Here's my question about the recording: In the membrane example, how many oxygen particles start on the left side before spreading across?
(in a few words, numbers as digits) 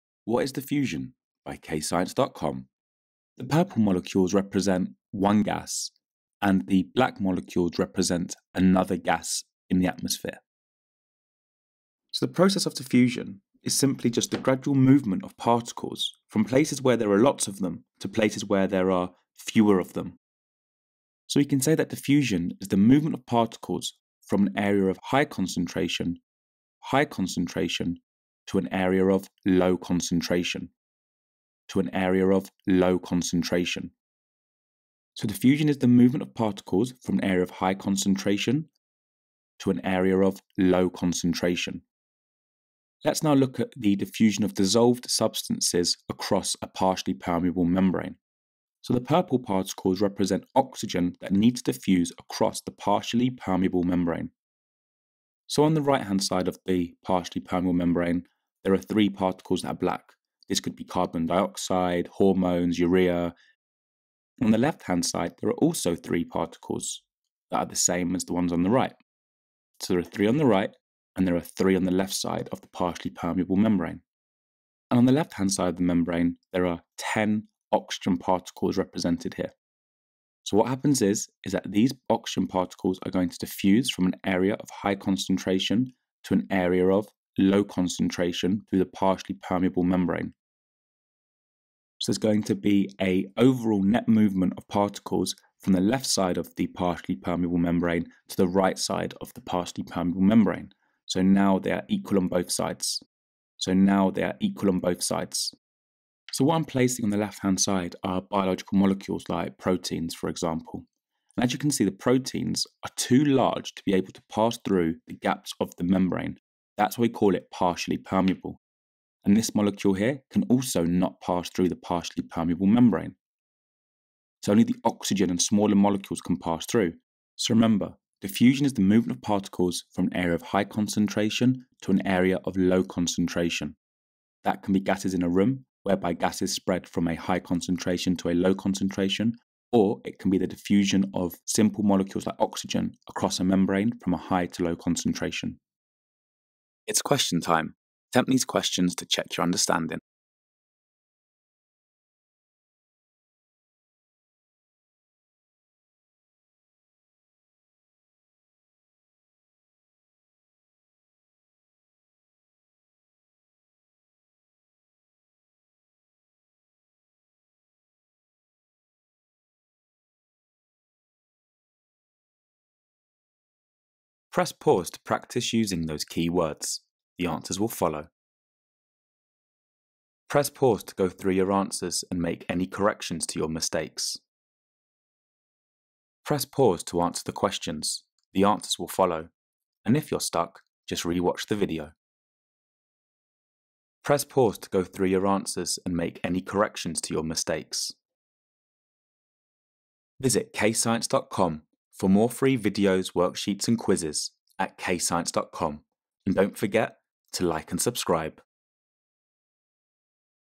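10.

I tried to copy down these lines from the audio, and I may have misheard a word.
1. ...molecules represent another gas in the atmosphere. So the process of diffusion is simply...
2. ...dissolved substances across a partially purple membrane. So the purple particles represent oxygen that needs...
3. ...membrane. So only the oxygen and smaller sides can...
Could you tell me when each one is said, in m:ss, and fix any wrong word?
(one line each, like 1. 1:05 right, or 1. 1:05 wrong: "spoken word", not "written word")
1. 0:07 right
2. 0:44 wrong: "permeable", not "purple"
3. 2:02 wrong: "molecules", not "sides".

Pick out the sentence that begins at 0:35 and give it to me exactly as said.
So diffusion is the movement of particles from an area of high concentration to an area of low concentration.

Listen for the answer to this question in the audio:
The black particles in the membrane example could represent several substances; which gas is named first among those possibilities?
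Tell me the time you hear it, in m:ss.
1:00.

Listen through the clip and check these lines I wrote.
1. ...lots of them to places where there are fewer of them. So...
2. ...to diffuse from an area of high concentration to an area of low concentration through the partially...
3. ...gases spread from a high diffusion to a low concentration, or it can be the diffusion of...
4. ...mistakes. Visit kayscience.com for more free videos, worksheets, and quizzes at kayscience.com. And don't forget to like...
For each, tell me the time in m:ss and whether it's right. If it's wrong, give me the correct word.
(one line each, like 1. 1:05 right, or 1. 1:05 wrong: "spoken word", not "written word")
1. 0:17 right
2. 1:23 right
3. 2:16 wrong: "concentration", not "diffusion"
4. 3:17 right.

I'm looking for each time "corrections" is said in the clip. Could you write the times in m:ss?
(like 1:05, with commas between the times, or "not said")
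3:02, 3:16.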